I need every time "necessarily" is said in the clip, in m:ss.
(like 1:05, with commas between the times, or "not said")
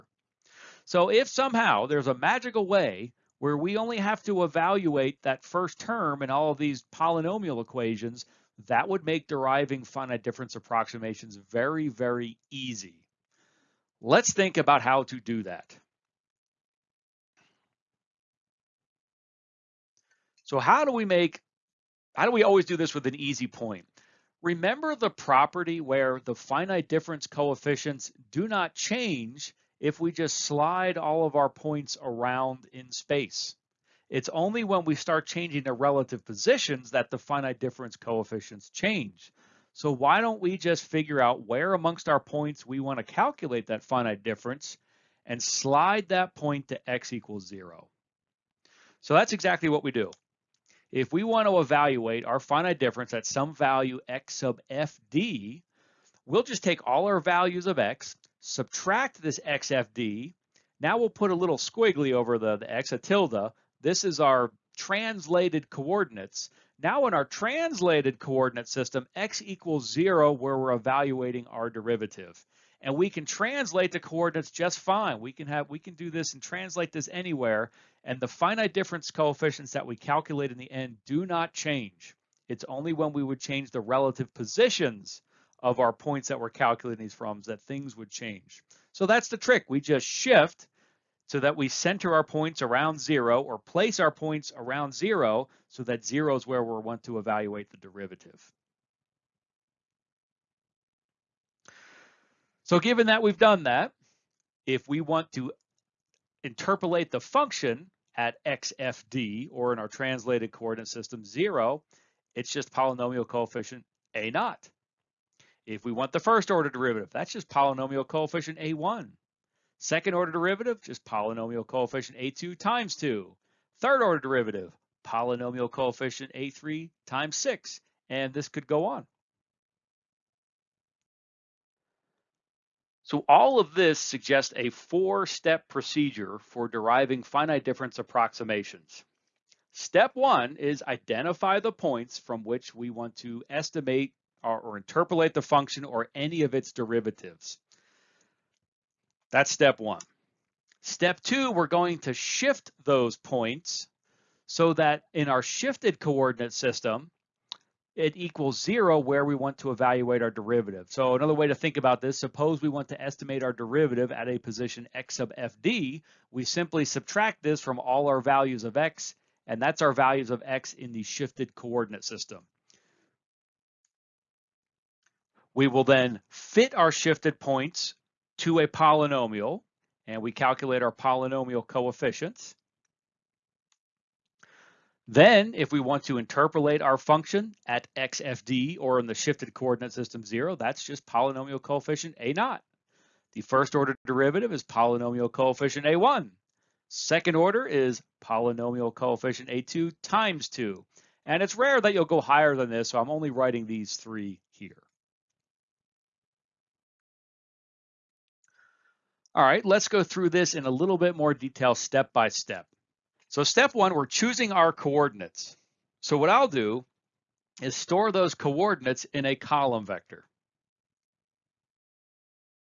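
not said.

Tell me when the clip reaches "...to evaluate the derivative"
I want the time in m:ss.
1:37.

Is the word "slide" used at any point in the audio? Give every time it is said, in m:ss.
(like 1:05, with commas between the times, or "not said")
0:30, 0:45.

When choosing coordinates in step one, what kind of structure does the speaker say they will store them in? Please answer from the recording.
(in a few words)
A column vector.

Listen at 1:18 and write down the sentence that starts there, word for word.
And the finite difference coefficients that we calculate in the end do not change.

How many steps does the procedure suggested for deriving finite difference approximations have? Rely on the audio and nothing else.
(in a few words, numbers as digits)
4.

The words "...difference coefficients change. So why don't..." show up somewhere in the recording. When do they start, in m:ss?
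0:37.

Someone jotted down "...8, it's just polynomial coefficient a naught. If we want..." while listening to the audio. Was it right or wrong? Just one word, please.
wrong.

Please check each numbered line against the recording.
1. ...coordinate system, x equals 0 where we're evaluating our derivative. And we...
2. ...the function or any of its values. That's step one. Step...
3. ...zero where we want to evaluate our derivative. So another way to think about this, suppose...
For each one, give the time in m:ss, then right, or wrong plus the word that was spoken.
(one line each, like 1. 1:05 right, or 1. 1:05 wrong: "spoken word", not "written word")
1. 1:08 right
2. 2:25 wrong: "derivatives", not "values"
3. 2:38 right.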